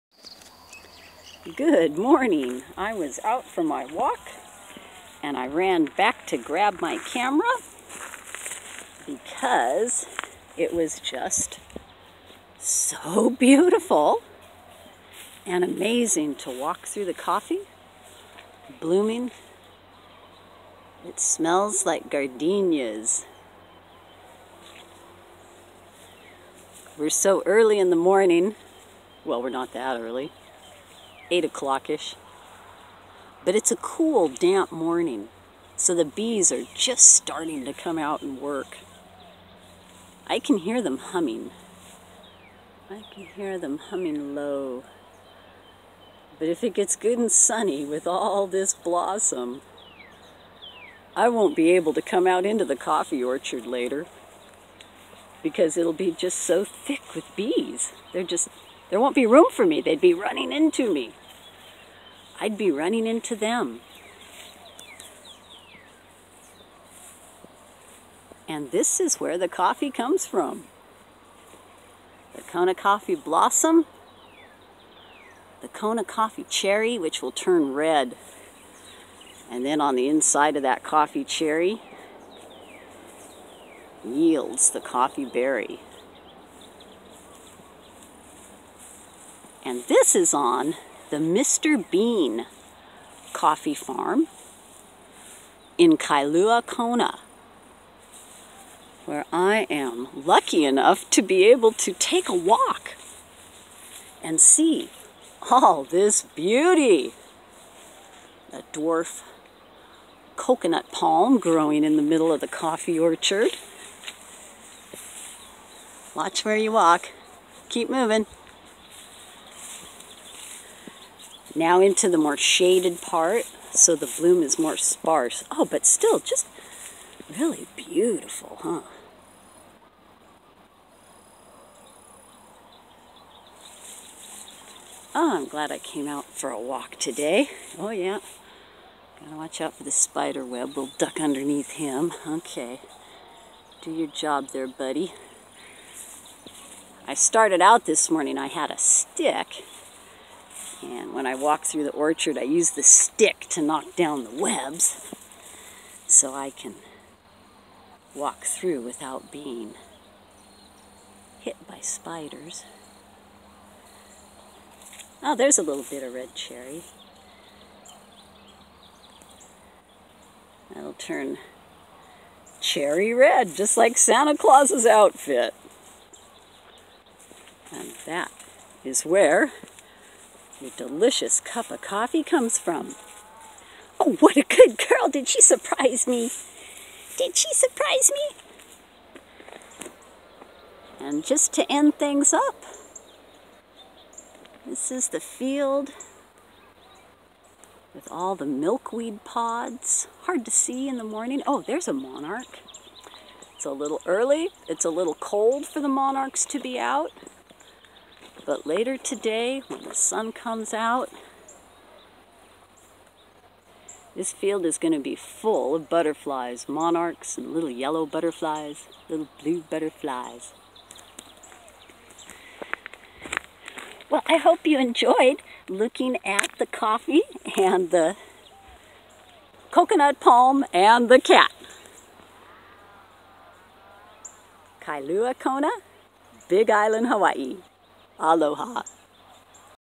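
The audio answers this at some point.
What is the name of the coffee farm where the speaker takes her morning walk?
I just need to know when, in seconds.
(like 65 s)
91 s.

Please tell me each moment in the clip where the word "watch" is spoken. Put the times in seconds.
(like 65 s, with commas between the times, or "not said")
116 s, 139 s.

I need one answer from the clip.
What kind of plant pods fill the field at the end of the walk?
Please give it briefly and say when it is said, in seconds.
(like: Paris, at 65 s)
Milkweed, at 198 s.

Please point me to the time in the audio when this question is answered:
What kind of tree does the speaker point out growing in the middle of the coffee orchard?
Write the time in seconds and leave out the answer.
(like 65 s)
108 s.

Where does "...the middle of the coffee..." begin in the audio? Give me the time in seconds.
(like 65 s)
111 s.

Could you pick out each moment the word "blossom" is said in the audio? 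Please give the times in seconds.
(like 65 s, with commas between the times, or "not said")
48 s, 73 s.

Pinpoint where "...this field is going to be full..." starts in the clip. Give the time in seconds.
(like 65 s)
214 s.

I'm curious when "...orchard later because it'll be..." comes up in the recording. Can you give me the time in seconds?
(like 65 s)
53 s.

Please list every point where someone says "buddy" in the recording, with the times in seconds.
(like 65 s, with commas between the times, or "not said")
144 s.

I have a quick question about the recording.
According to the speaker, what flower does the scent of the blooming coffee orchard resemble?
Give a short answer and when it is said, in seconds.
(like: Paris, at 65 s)
Gardenias, at 22 s.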